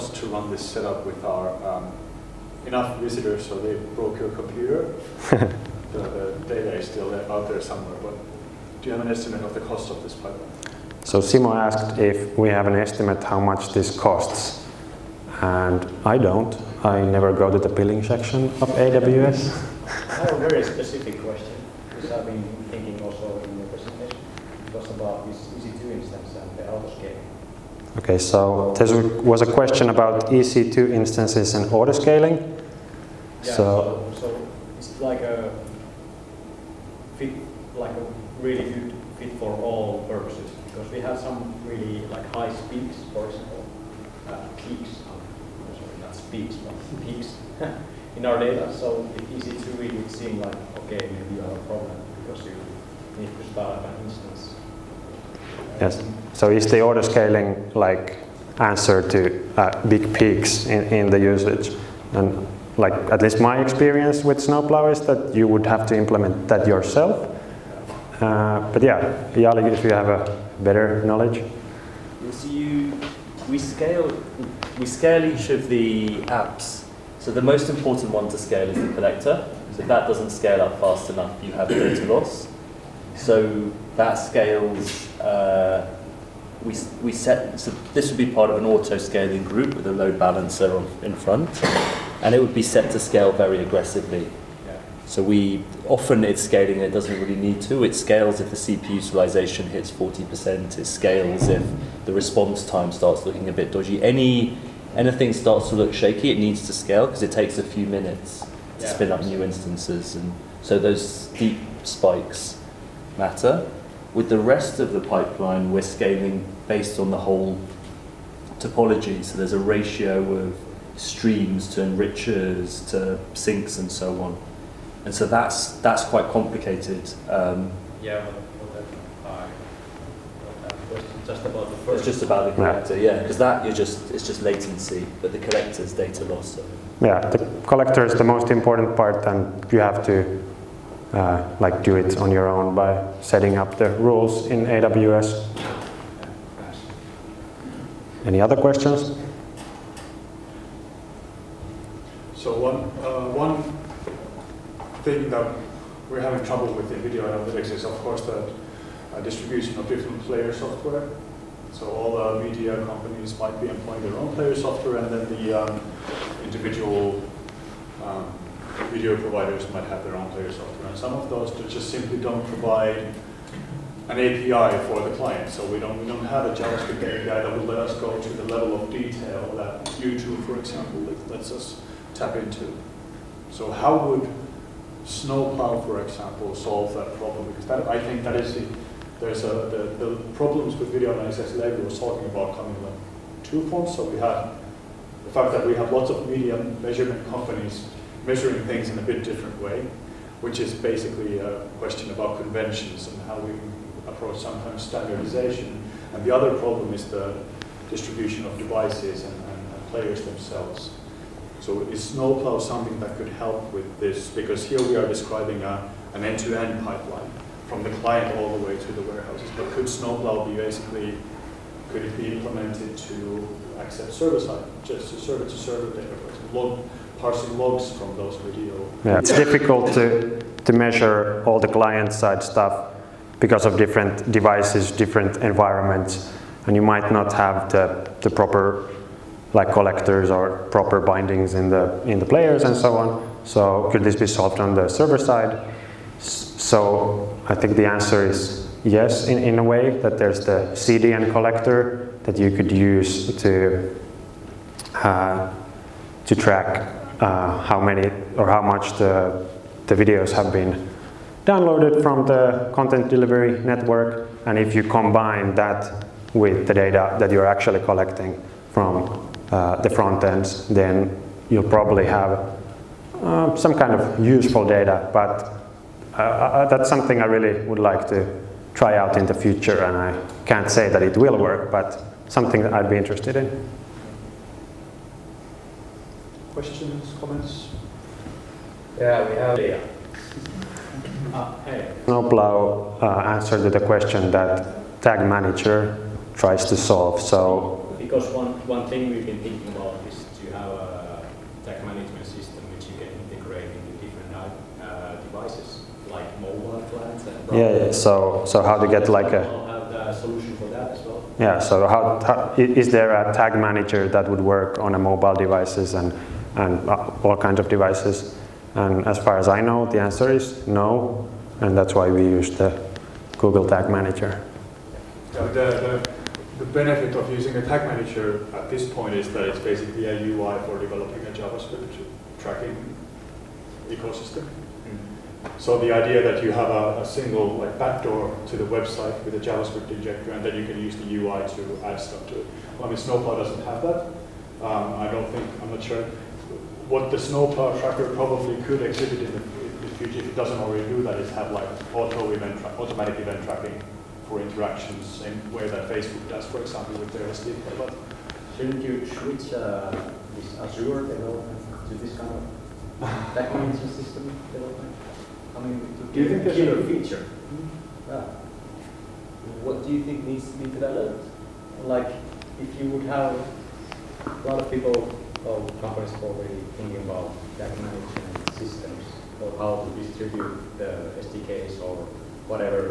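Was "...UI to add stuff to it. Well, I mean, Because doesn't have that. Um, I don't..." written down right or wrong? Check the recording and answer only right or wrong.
wrong.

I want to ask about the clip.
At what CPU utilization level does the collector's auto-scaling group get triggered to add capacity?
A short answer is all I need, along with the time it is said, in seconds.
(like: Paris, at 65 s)
40%, at 99 s.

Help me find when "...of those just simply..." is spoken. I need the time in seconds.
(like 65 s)
171 s.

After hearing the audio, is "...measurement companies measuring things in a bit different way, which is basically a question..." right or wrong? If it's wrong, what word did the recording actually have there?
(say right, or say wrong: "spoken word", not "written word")
right.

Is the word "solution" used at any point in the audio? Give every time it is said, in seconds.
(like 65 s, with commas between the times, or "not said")
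310 s.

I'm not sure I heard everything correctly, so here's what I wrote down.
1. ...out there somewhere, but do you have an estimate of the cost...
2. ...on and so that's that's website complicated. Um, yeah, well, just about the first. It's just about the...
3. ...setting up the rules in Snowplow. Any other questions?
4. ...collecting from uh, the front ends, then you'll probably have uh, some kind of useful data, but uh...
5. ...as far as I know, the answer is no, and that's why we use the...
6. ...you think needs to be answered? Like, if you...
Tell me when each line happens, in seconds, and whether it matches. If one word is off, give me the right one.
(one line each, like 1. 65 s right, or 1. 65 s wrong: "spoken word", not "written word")
1. 7 s right
2. 124 s wrong: "quite", not "website"
3. 143 s wrong: "AWS", not "Snowplow"
4. 267 s right
5. 319 s right
6. 369 s wrong: "developed", not "answered".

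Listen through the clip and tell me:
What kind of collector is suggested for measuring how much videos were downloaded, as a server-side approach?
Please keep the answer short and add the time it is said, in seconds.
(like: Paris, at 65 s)
CDN collector, at 250 s.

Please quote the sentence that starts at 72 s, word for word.
So you, we scale, we scale each of the apps.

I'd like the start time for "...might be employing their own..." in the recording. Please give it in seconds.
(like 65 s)
163 s.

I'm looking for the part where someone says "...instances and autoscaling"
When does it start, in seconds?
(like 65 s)
30 s.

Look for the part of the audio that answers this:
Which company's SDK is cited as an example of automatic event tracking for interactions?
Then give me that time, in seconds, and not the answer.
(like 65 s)
355 s.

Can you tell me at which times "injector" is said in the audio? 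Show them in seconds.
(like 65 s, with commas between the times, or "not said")
339 s.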